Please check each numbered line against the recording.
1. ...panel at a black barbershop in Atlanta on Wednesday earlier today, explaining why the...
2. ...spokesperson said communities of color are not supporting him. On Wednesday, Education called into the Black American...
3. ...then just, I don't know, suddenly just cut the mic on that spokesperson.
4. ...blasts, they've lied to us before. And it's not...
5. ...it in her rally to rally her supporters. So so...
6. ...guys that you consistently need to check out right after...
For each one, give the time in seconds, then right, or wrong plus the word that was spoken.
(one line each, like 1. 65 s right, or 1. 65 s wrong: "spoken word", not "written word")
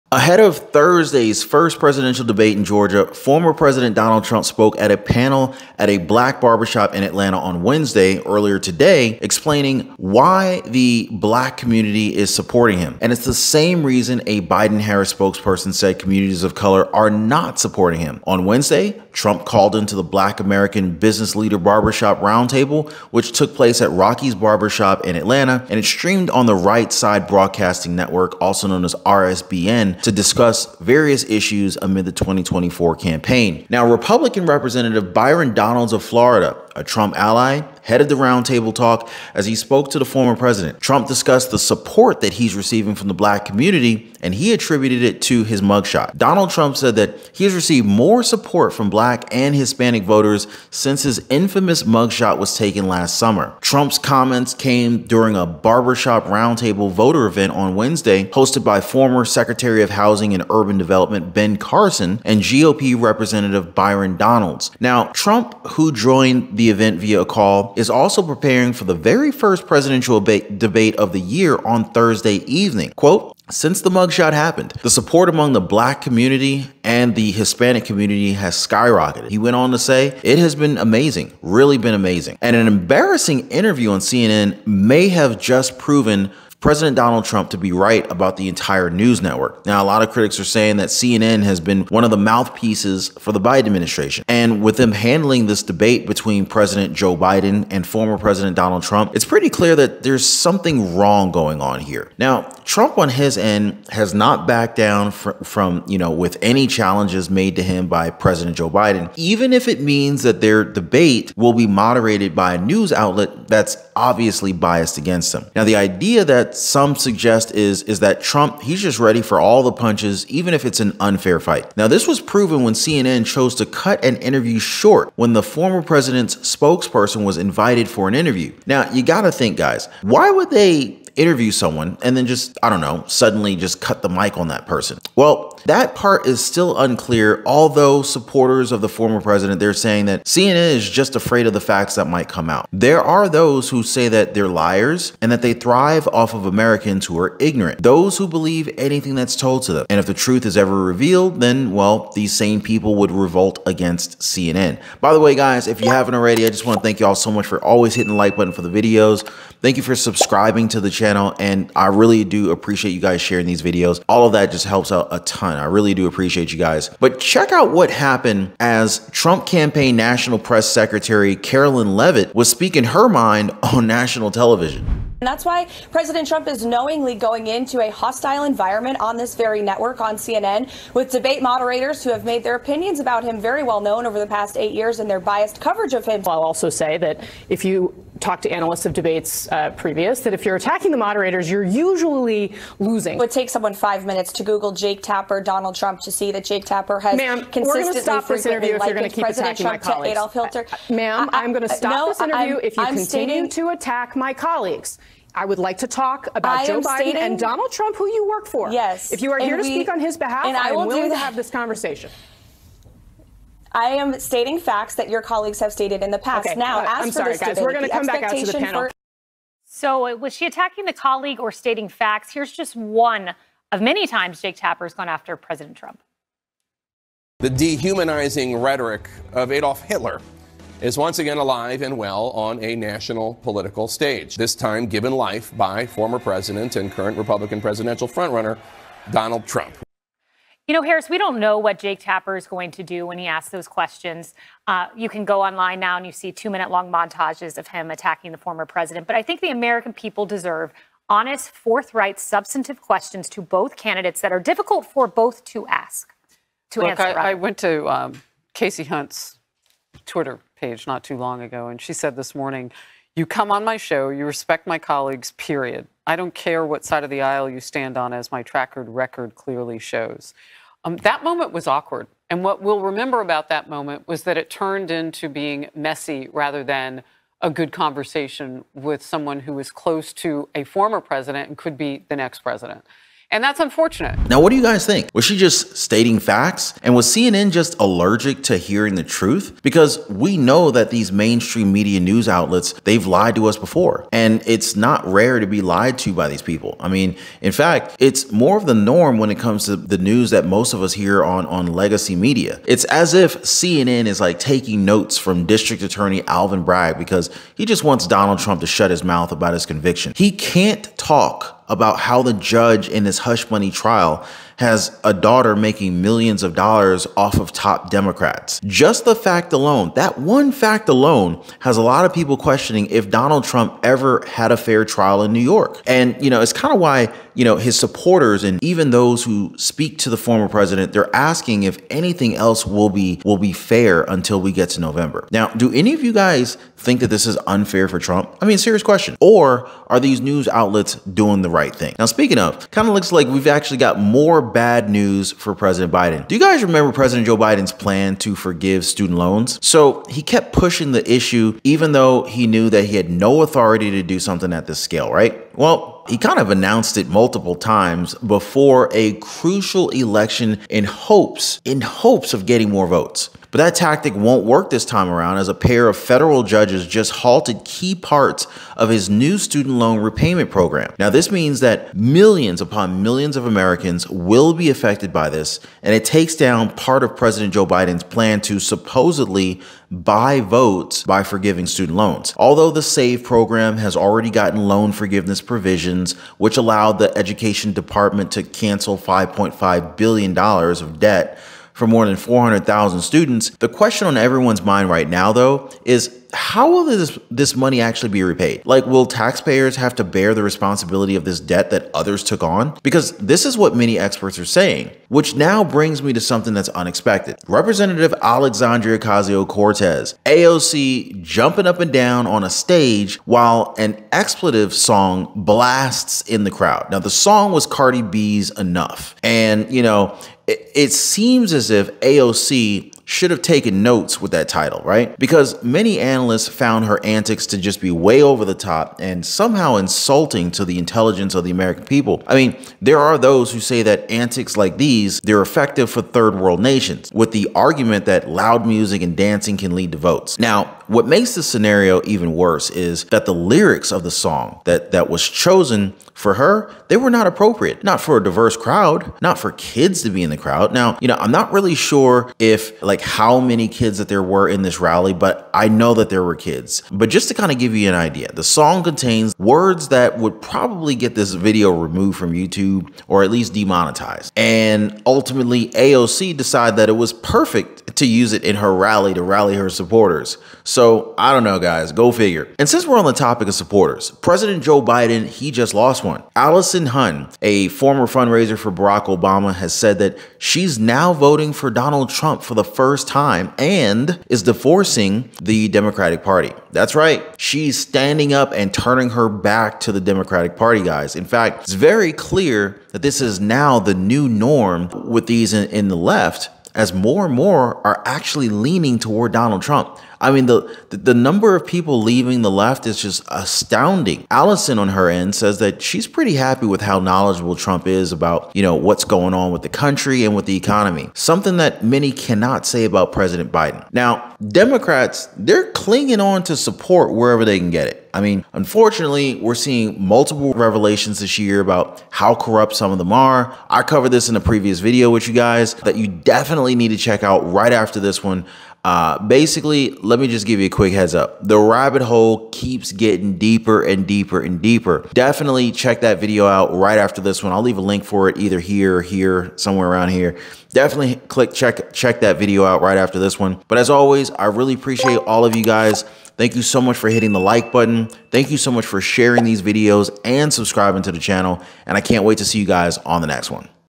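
1. 4 s right
2. 15 s wrong: "Trump", not "Education"
3. 132 s wrong: "person", not "spokesperson"
4. 292 s wrong: "outlets", not "blasts"
5. 468 s right
6. 525 s wrong: "definitely", not "consistently".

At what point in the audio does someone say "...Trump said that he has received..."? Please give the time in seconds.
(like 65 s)
46 s.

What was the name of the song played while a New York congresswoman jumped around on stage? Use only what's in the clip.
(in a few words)
Enough.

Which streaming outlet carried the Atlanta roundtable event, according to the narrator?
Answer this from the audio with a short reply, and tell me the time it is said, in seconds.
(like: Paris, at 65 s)
Right Side Broadcasting Network, at 26 s.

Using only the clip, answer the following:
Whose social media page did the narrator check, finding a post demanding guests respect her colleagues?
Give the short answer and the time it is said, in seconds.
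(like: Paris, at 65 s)
Kasie Hunt, at 258 s.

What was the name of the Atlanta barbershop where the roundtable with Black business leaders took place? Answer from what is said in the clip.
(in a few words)
Rocky's Barbershop.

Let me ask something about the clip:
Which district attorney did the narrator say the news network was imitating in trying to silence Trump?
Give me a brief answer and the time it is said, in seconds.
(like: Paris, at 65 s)
Alvin Bragg, at 306 s.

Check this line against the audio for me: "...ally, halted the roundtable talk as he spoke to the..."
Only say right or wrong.
wrong.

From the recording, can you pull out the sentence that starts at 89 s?
Now, a lot of critics are saying that CNN has been one of the mouthpieces for the Biden administration.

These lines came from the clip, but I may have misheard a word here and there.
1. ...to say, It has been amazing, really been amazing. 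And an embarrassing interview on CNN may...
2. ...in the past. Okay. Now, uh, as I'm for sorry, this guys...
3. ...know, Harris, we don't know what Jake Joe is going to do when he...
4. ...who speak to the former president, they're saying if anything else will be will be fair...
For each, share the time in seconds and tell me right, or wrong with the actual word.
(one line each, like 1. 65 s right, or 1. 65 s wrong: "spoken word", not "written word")
1. 79 s right
2. 216 s right
3. 240 s wrong: "Tapper", not "Joe"
4. 329 s wrong: "asking", not "saying".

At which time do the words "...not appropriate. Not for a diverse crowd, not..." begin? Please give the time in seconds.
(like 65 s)
447 s.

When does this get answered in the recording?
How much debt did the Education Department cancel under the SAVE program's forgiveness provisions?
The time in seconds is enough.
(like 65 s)
388 s.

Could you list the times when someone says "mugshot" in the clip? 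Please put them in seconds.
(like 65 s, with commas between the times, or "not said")
45 s, 51 s, 73 s.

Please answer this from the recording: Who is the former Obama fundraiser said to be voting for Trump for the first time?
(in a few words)
Allison Huynh.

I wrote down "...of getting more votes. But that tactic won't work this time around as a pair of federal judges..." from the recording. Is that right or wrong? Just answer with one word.
right.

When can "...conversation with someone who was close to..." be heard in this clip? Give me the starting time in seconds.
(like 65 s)
277 s.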